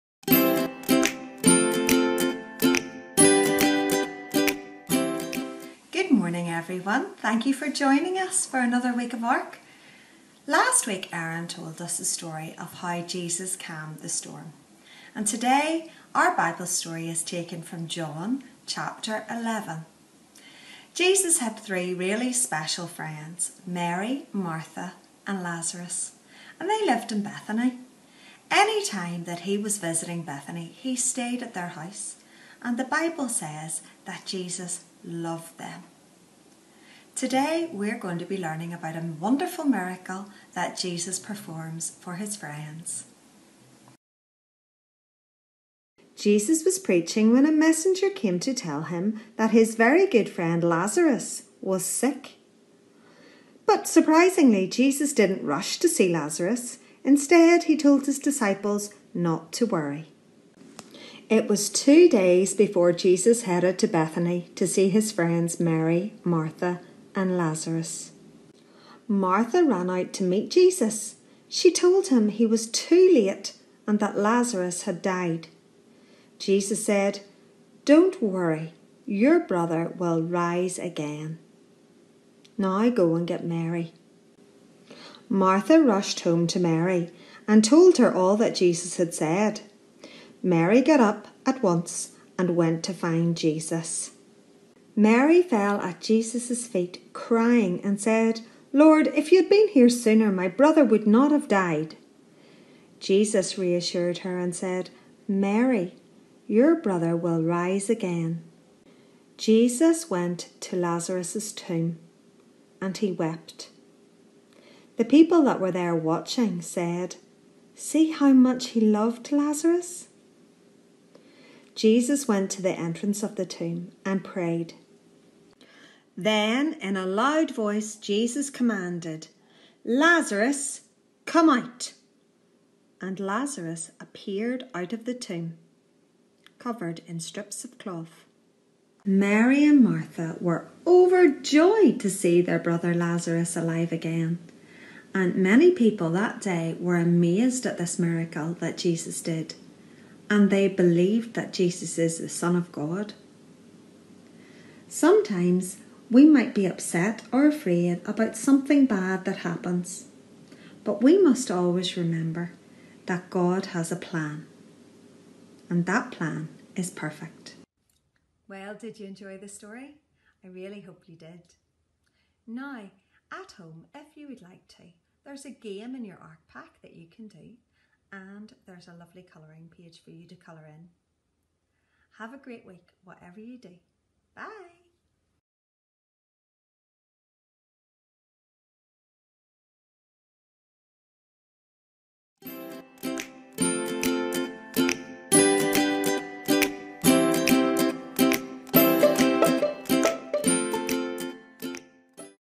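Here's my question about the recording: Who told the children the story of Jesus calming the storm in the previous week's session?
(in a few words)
Aaron.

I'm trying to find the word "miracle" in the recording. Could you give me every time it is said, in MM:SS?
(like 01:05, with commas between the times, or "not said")
00:39, 02:27.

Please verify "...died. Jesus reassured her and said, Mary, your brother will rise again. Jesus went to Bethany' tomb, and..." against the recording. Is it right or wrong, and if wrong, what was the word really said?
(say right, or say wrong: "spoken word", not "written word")
wrong: "Lazarus", not "Bethany".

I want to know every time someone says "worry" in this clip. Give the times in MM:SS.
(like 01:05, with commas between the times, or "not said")
00:59, 01:18.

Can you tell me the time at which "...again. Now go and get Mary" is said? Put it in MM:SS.
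01:20.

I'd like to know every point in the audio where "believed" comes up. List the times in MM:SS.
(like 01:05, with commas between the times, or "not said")
02:30.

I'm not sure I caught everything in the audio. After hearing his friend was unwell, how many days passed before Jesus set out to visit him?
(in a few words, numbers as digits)
2.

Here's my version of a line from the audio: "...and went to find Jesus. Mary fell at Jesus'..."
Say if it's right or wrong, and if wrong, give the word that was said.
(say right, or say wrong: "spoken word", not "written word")
right.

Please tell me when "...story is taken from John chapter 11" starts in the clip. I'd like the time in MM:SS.
00:16.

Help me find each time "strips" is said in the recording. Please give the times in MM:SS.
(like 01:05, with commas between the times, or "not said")
02:17.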